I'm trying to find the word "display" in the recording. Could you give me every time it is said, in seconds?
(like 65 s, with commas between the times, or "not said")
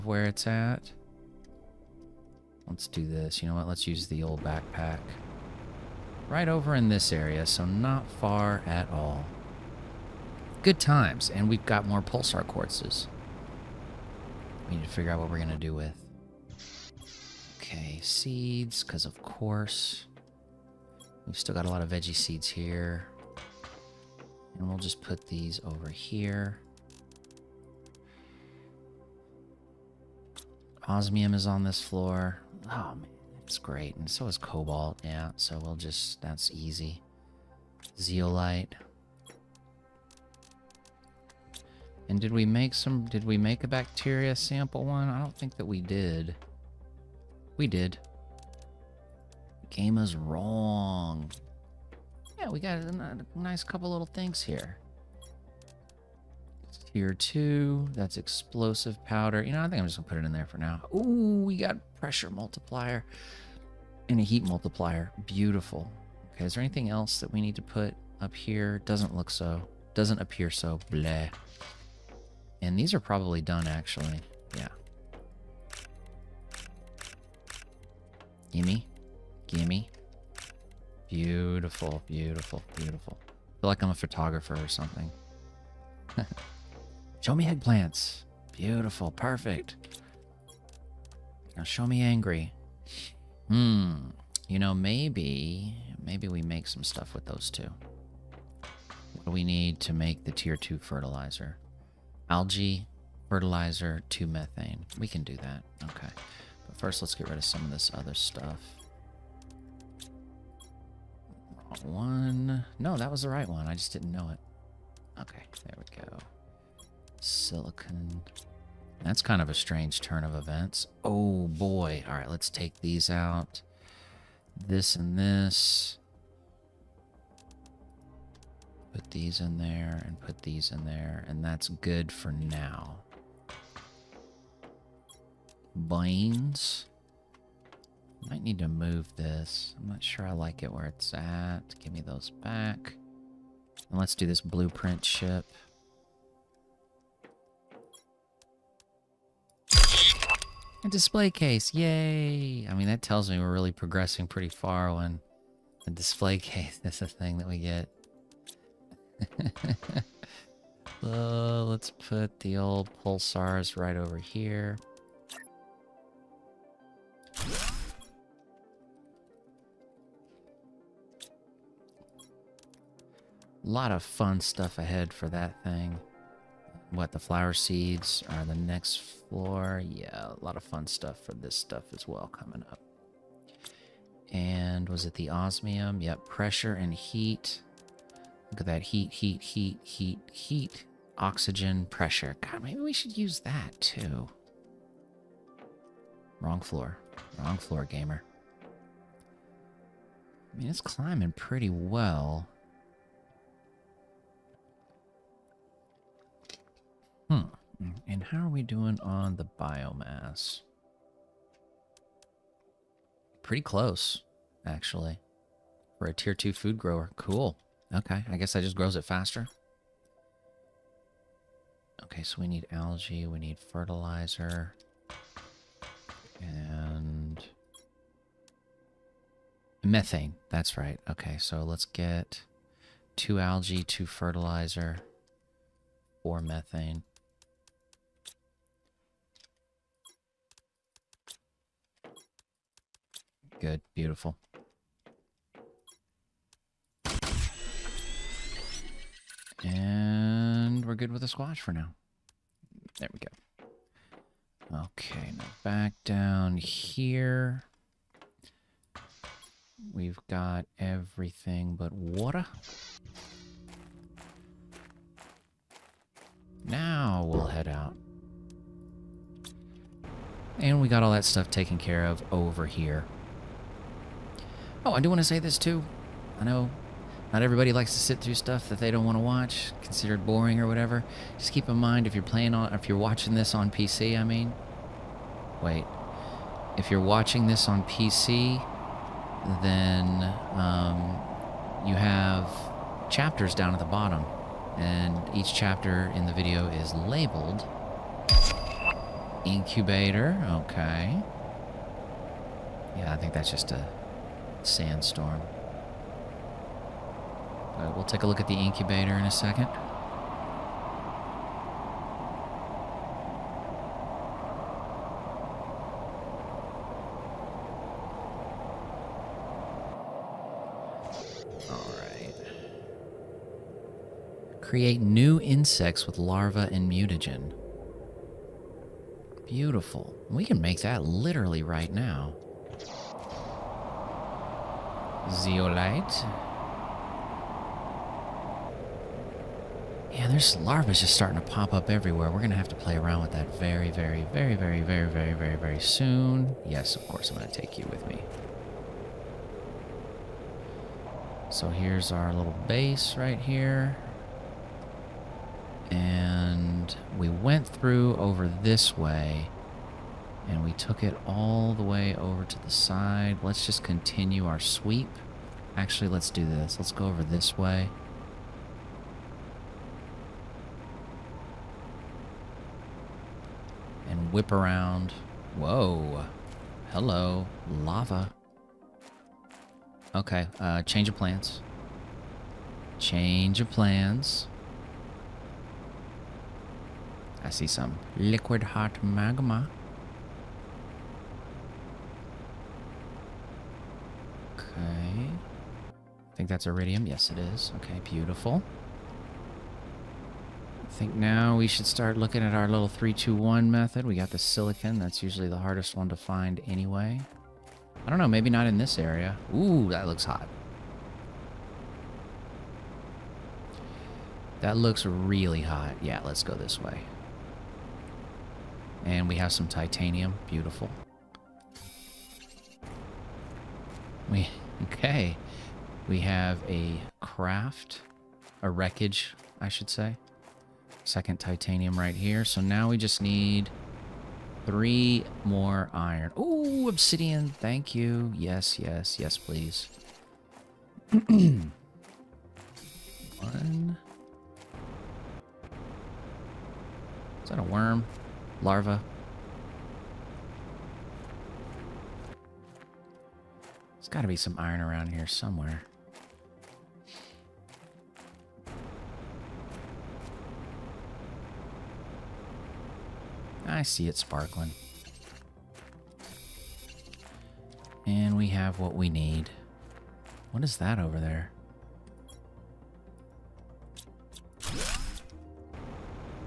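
150 s, 155 s.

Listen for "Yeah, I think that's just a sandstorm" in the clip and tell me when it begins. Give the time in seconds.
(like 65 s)
302 s.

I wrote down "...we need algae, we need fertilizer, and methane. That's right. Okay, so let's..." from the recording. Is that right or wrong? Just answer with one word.
right.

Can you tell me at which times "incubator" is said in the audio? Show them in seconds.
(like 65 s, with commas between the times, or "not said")
299 s, 308 s.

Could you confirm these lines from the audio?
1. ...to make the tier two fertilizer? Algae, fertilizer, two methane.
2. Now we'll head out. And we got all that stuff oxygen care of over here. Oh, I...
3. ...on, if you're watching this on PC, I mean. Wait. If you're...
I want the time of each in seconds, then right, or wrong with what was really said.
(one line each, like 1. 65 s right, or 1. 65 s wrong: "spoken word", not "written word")
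1. 99 s right
2. 266 s wrong: "taken", not "oxygen"
3. 282 s right.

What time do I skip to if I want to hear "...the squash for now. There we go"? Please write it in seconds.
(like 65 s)
251 s.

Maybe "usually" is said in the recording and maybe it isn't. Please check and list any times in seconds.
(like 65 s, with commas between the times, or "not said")
405 s.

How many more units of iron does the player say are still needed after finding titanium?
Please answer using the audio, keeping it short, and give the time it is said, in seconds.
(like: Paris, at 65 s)
3, at 434 s.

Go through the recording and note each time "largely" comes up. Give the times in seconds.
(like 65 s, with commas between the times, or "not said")
not said.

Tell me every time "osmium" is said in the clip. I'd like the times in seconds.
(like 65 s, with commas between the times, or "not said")
30 s, 185 s.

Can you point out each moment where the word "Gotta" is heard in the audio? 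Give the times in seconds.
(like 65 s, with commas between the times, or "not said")
454 s.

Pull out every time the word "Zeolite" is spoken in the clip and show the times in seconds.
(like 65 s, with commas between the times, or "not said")
37 s, 335 s.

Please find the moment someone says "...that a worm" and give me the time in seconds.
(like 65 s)
447 s.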